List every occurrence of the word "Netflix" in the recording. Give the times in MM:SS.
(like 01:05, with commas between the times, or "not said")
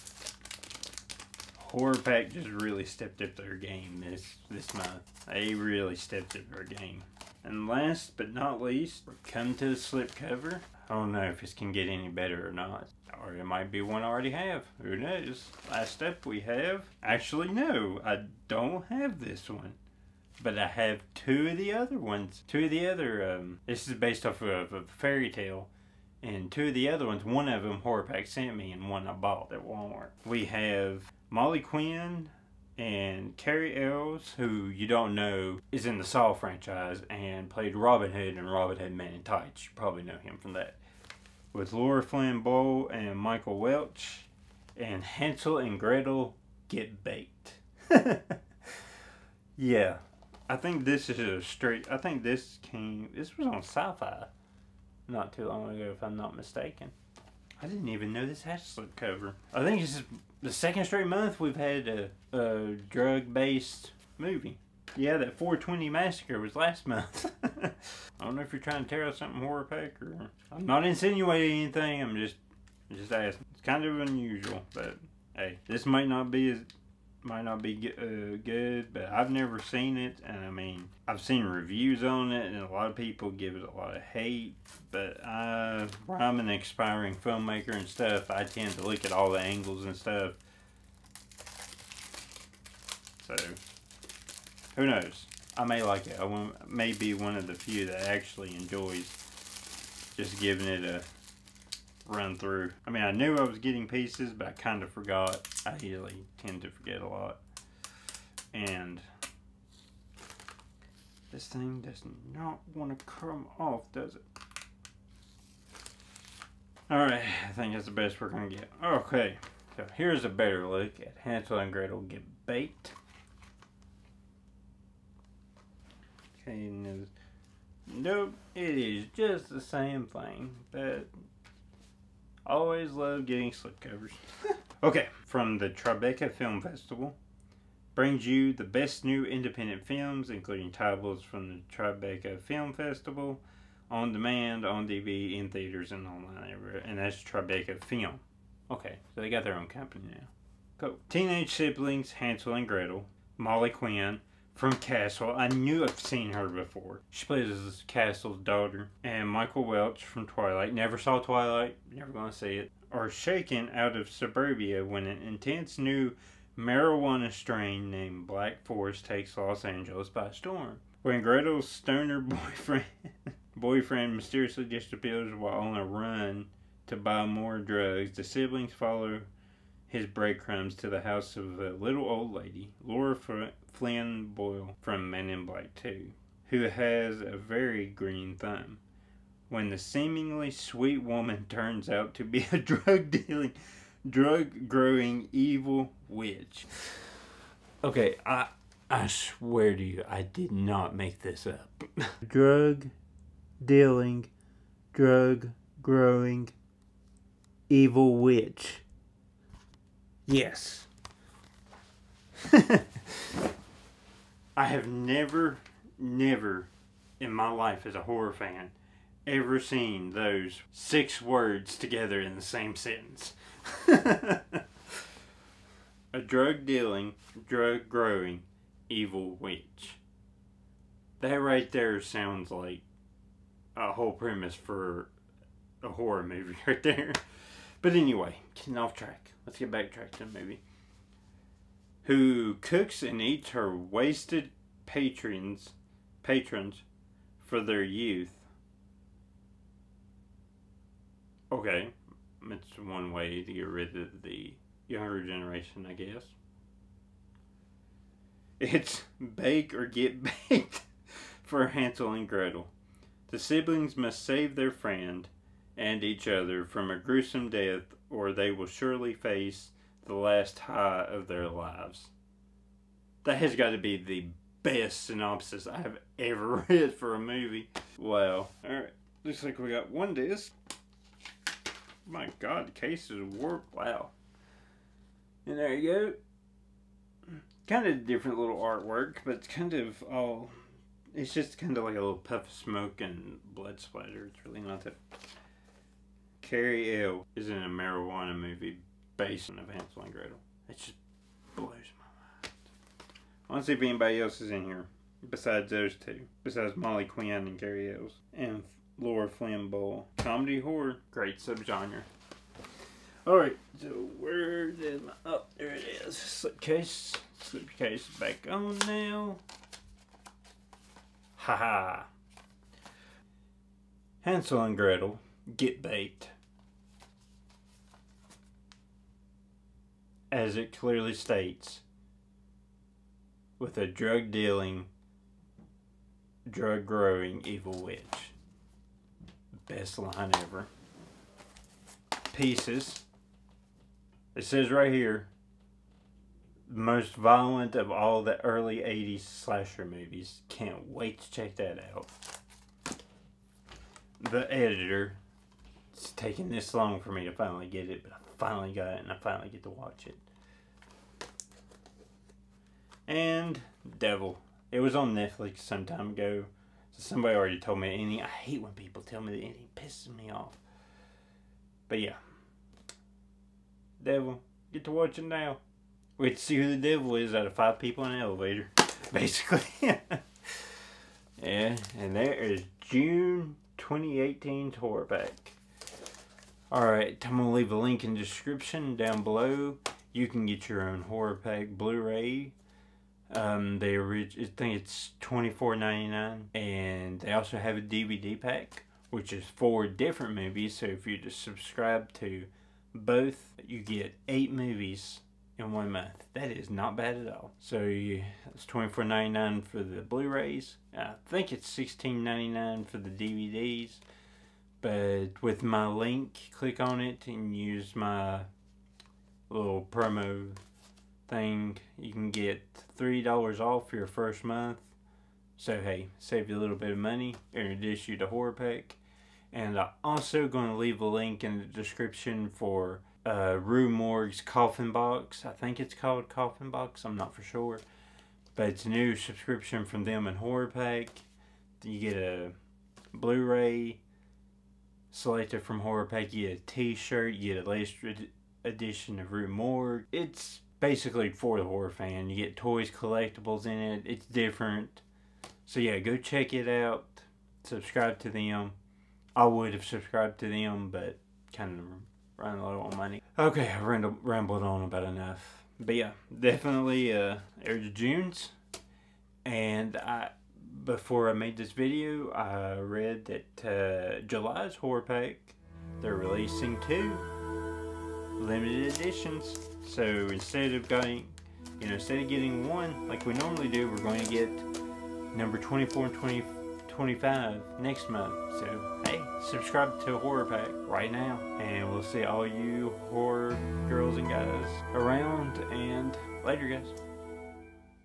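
06:05.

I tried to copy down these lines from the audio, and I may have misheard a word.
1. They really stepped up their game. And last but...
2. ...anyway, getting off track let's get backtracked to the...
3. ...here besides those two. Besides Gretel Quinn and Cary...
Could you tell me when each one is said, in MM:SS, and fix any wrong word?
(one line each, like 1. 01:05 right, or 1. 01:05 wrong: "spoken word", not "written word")
1. 00:05 right
2. 03:57 right
3. 05:04 wrong: "Molly", not "Gretel".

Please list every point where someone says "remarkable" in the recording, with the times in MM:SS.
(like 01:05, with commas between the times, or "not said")
not said.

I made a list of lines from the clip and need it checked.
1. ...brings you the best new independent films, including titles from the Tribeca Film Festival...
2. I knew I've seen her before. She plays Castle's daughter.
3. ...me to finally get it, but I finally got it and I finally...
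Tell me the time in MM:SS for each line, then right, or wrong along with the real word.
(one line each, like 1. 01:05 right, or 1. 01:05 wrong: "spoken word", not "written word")
1. 02:17 right
2. 02:35 right
3. 05:57 right.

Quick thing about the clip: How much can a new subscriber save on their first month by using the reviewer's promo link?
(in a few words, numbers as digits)
$3.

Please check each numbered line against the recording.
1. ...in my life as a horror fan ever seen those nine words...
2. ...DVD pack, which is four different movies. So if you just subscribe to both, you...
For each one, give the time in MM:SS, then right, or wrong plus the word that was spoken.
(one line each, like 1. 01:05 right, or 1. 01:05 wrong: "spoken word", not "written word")
1. 03:37 wrong: "six", not "nine"
2. 06:37 right.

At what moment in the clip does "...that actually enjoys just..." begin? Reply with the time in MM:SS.
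01:37.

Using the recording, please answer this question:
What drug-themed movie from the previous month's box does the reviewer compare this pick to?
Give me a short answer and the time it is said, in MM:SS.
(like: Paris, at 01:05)
420 Massacre, at 01:05.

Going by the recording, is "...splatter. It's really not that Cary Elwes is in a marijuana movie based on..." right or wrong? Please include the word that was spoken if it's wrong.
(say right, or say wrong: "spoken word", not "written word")
right.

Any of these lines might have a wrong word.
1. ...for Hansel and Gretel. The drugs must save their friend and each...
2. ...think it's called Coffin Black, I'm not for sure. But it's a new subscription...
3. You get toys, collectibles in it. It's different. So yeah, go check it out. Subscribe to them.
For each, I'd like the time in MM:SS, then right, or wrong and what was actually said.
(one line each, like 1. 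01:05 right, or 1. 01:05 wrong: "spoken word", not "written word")
1. 04:21 wrong: "siblings", not "drugs"
2. 07:15 wrong: "Box", not "Black"
3. 07:32 right.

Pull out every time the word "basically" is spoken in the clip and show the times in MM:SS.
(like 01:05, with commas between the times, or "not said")
06:19, 07:30.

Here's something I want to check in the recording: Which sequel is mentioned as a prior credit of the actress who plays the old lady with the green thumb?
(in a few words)
Men in Black 2.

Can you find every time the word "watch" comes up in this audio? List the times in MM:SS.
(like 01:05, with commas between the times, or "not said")
05:59, 06:14.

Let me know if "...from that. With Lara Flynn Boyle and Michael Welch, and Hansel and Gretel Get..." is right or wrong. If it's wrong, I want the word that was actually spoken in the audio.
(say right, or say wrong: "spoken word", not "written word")
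right.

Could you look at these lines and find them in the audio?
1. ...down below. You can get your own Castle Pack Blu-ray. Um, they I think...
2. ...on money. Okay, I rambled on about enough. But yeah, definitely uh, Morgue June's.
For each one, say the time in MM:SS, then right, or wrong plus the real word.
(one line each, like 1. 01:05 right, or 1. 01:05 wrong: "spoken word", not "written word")
1. 06:28 wrong: "Horror", not "Castle"
2. 07:42 wrong: "Air", not "Morgue".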